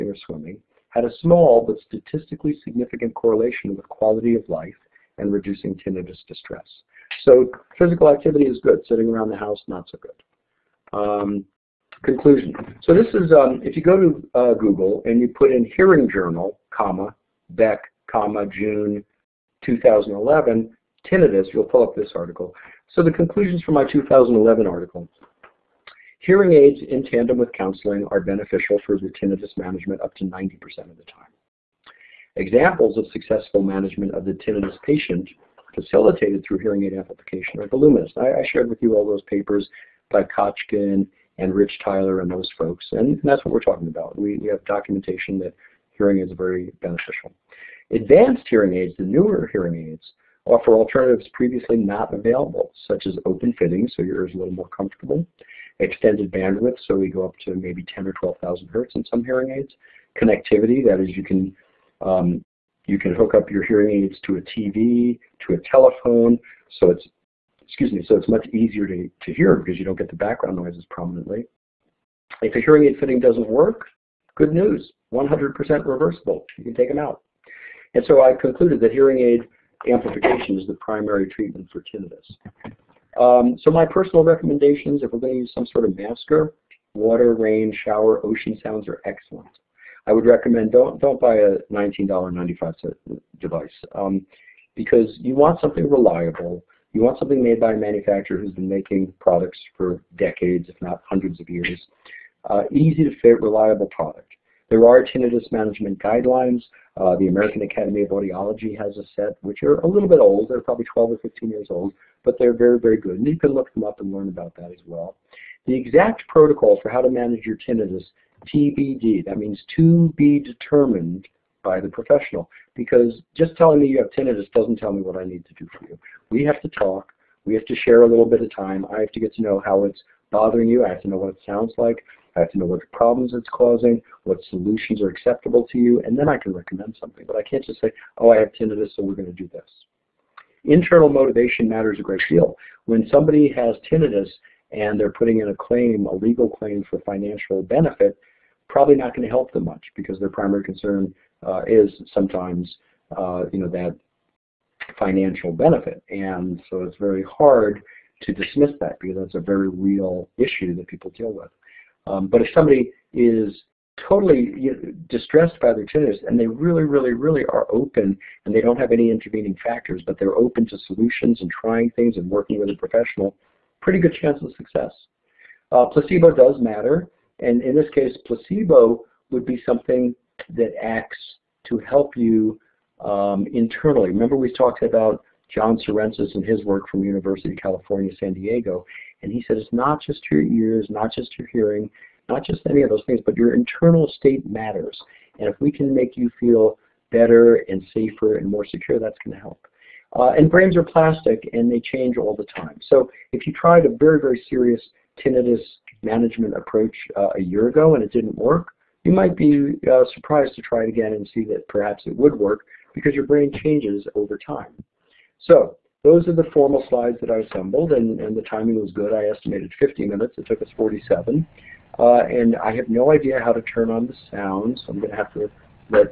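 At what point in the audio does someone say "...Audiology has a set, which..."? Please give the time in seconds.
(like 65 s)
108 s.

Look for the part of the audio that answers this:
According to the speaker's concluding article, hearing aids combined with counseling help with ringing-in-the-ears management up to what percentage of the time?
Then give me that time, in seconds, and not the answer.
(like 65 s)
30 s.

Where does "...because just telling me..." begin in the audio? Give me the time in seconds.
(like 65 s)
122 s.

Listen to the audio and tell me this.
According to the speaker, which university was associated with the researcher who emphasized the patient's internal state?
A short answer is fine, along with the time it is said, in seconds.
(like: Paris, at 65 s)
University of California, San Diego, at 187 s.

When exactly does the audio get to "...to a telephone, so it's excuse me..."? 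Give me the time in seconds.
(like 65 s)
65 s.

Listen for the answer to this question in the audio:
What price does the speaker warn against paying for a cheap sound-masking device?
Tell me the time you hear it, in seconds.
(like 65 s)
91 s.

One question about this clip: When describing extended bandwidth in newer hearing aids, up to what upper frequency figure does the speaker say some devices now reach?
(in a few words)
12,000 hertz.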